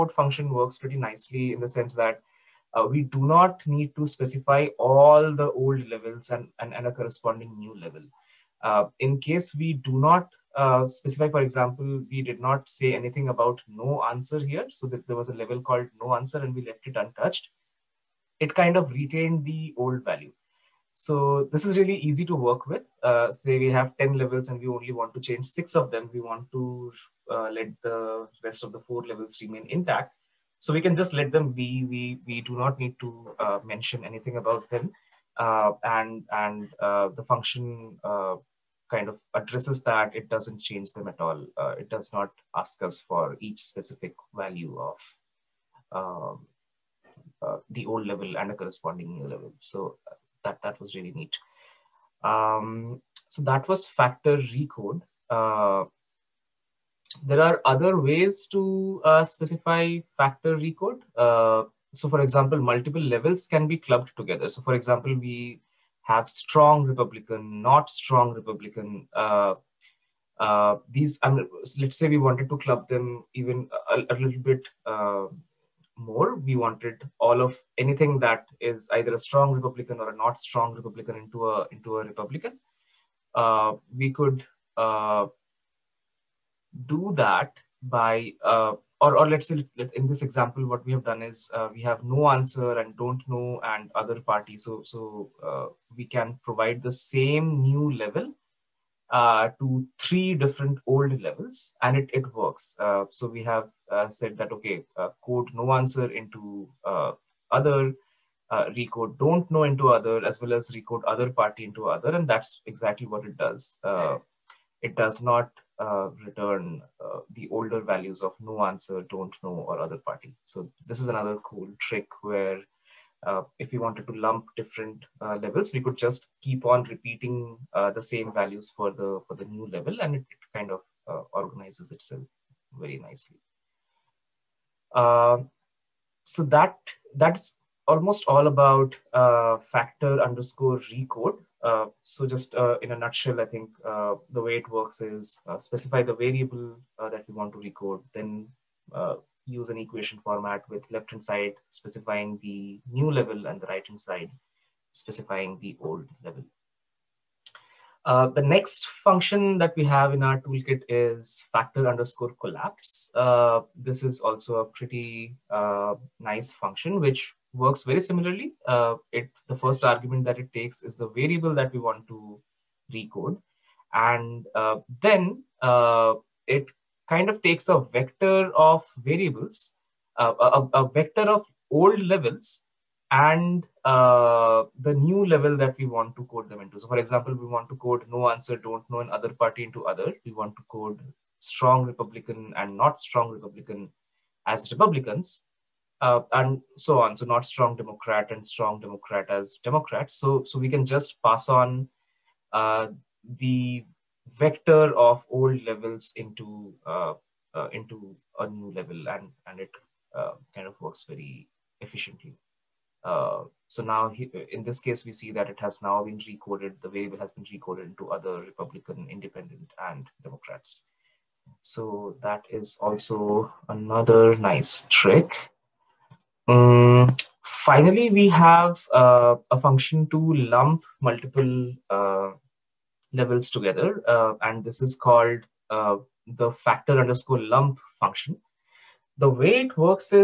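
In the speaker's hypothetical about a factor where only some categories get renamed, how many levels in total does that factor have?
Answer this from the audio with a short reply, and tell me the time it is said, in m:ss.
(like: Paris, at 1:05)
10, at 0:23.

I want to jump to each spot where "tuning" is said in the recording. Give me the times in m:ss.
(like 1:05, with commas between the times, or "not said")
not said.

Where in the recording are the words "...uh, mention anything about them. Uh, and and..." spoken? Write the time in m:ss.
0:33.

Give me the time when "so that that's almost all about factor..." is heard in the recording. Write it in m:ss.
2:16.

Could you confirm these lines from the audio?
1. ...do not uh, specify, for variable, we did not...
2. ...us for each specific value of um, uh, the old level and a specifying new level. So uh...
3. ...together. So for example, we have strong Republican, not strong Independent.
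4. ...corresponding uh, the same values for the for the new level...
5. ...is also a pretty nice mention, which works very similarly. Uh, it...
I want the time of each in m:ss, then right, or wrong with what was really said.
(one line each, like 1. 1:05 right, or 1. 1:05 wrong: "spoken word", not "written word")
1. 0:09 wrong: "example", not "variable"
2. 0:42 wrong: "corresponding", not "specifying"
3. 1:04 wrong: "Republican", not "Independent"
4. 2:06 wrong: "repeating", not "corresponding"
5. 2:44 wrong: "function", not "mention".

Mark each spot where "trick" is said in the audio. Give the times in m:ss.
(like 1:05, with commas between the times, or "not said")
2:01, 3:44.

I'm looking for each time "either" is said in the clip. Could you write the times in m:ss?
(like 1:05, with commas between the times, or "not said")
1:18.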